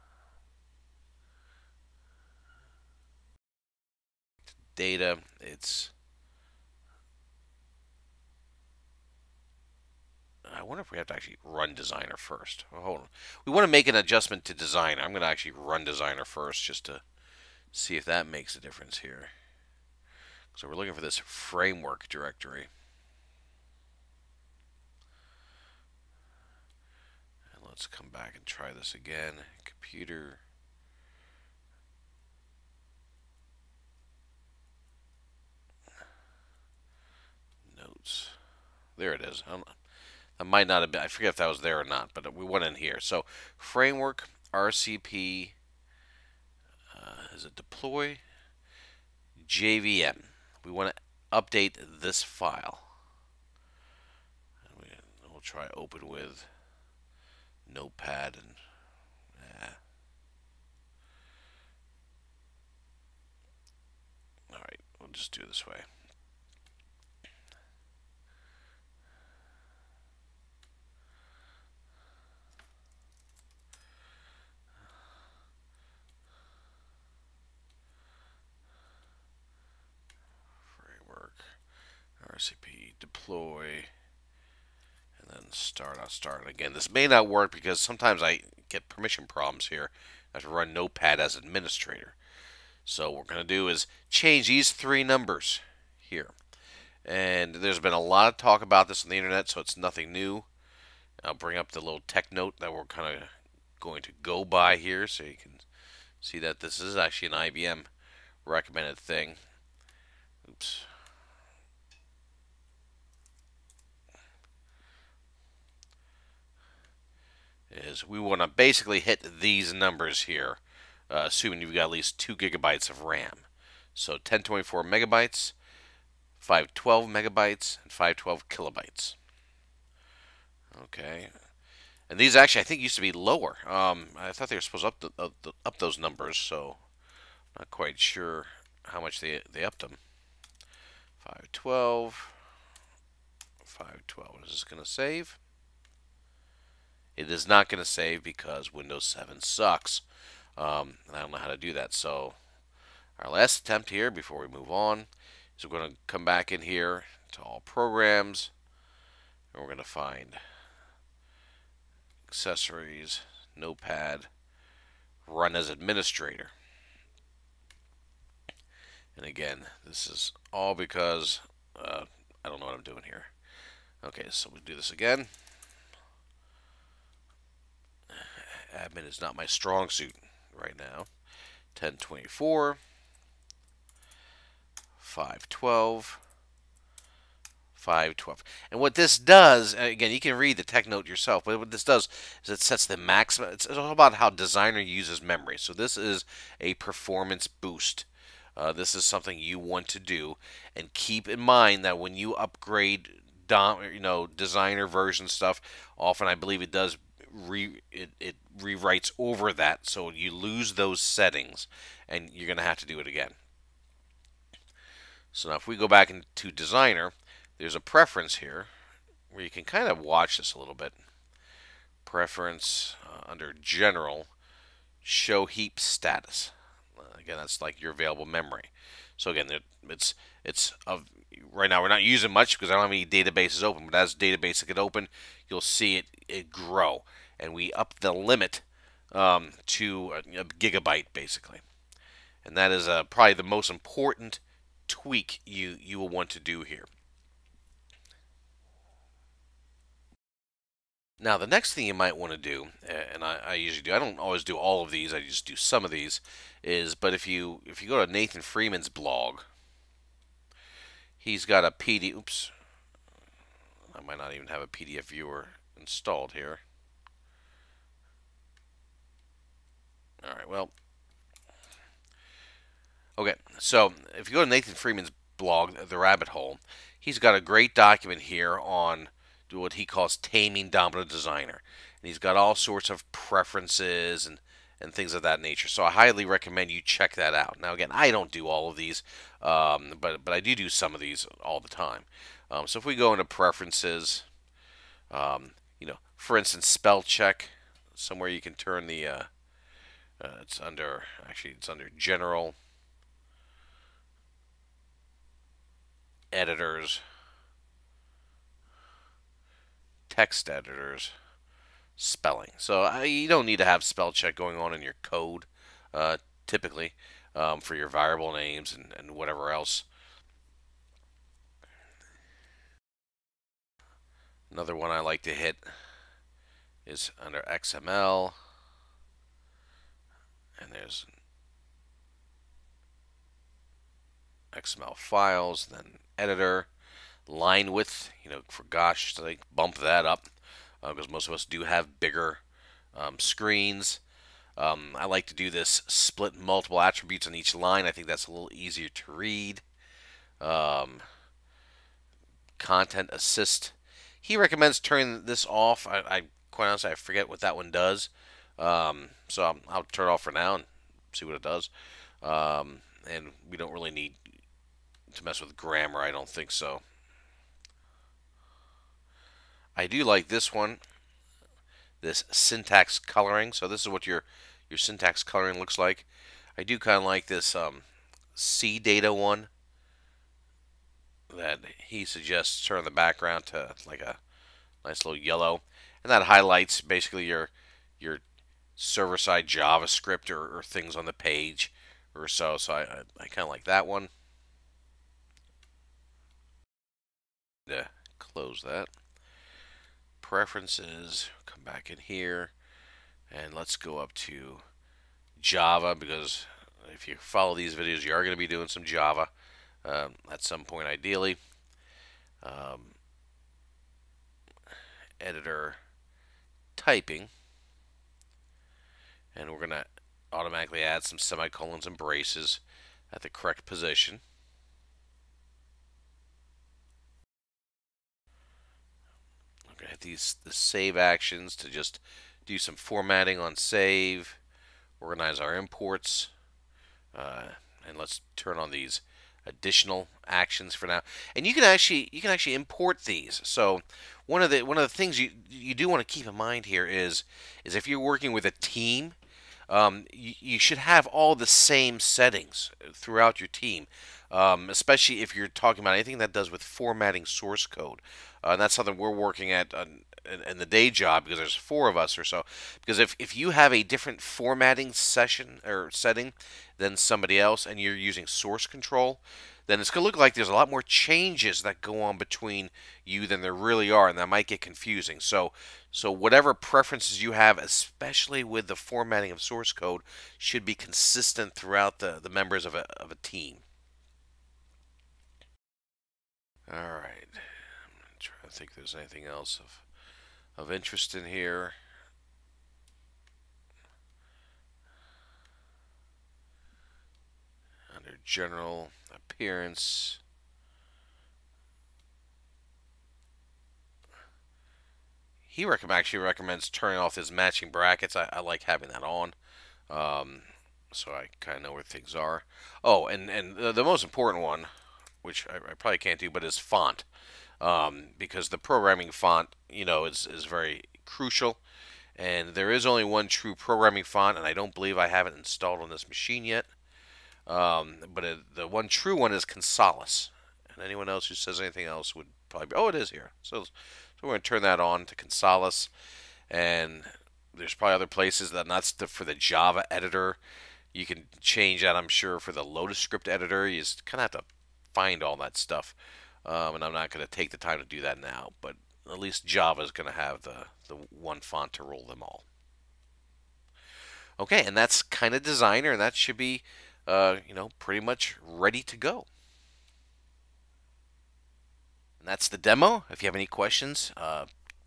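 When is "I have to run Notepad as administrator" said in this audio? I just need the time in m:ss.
1:30.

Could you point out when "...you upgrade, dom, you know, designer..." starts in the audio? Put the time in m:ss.
3:22.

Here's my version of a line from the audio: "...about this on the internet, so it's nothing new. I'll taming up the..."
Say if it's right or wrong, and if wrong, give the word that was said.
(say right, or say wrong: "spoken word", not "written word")
wrong: "bring", not "taming".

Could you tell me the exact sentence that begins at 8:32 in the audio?
Oh, and, and the, the most important one, which I, I, probably can't do, but is font.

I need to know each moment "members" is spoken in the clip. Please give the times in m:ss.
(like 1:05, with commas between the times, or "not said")
8:02.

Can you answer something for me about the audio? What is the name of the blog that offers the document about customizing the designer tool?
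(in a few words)
The Rabbit Hole.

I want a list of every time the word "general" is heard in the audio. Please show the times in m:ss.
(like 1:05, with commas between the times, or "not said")
3:43, 5:01, 8:18.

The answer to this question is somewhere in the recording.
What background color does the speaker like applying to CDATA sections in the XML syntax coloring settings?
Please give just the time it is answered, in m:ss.
6:25.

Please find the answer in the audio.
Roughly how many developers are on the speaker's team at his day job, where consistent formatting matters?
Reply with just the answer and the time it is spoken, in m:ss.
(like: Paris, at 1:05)
4, at 7:41.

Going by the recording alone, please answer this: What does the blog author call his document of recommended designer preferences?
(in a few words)
taming Domino designer.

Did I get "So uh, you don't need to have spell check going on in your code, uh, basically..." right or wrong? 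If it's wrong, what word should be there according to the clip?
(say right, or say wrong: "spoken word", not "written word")
wrong: "typically", not "basically".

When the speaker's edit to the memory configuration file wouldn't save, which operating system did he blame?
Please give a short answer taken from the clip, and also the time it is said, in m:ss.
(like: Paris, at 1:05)
Windows 7, at 2:28.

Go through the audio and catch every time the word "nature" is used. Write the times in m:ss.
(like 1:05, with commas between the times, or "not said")
4:45.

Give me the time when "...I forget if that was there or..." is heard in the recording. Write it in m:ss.
0:41.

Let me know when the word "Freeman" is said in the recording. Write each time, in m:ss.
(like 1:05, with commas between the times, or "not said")
4:18, 4:34.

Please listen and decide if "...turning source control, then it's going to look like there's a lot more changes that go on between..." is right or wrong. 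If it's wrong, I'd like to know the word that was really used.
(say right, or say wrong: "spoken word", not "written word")
wrong: "using", not "turning".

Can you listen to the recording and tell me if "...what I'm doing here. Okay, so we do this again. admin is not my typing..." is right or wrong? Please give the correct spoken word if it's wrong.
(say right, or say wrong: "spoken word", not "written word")
wrong: "strong", not "typing".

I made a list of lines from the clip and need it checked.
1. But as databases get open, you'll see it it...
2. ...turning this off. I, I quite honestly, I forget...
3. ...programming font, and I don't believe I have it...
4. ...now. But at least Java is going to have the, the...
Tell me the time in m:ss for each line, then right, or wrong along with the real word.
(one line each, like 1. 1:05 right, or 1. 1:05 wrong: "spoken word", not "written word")
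1. 3:53 right
2. 5:54 right
3. 8:43 right
4. 9:08 right.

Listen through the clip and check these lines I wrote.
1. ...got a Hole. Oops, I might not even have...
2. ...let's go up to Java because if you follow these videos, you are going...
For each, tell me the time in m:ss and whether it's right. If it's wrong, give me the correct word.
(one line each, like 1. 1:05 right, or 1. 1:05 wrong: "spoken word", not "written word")
1. 4:21 wrong: "PDF", not "Hole"
2. 6:43 right.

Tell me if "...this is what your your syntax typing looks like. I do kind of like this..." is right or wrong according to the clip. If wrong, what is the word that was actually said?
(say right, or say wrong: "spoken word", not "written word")
wrong: "coloring", not "typing".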